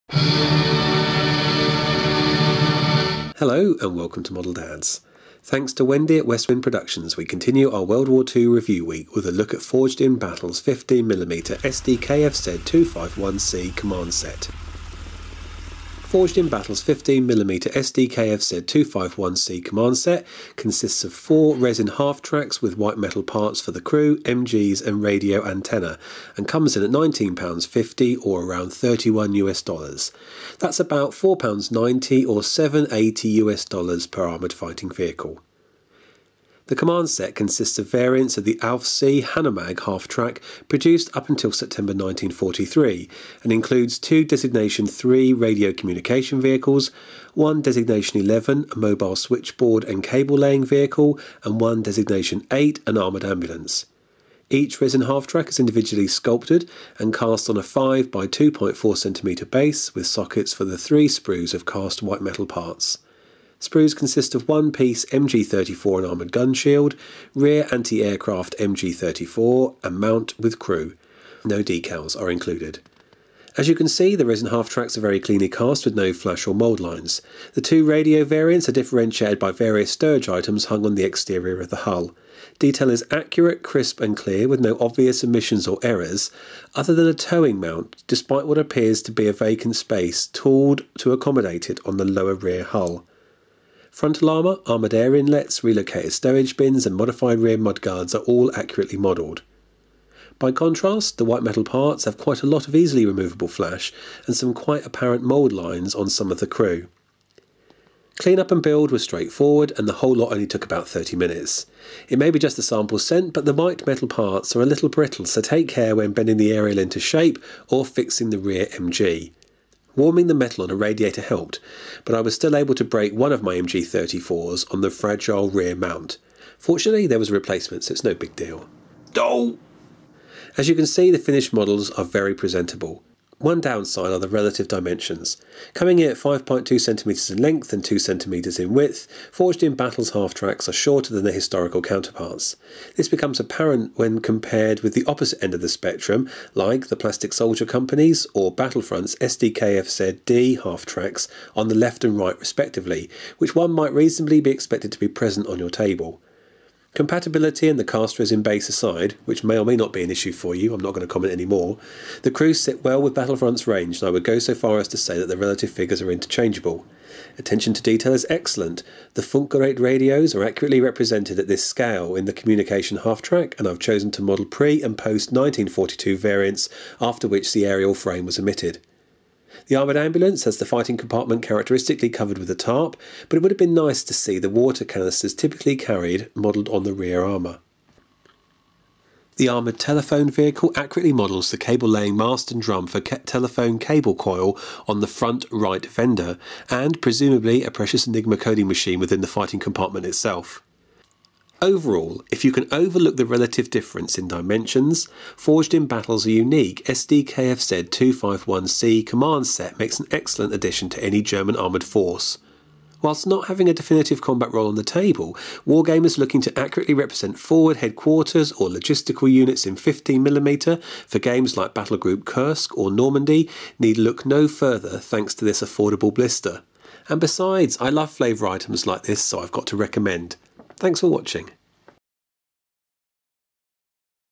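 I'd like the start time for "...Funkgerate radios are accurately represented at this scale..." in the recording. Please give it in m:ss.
2:49.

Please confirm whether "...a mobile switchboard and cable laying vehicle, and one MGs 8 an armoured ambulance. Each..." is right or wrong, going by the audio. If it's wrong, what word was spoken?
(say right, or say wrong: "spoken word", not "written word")
wrong: "Designation", not "MGs".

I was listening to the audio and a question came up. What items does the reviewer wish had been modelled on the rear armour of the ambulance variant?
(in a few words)
water canisters.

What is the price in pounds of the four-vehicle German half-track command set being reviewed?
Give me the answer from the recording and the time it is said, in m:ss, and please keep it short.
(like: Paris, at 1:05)
£19.50, at 0:26.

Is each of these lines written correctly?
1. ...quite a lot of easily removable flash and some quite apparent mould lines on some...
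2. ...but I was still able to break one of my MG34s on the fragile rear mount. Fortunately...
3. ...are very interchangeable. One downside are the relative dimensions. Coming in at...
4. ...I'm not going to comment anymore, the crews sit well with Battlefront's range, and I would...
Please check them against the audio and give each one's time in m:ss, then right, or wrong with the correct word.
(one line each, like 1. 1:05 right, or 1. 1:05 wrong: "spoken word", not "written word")
1. 1:42 right
2. 2:02 right
3. 2:11 wrong: "presentable", not "interchangeable"
4. 2:40 right.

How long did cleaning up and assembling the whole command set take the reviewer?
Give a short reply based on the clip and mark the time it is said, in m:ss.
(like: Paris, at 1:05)
about 30 minutes, at 1:50.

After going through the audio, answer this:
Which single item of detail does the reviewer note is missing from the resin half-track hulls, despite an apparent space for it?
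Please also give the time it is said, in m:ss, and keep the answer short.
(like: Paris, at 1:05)
a towing mount, at 1:27.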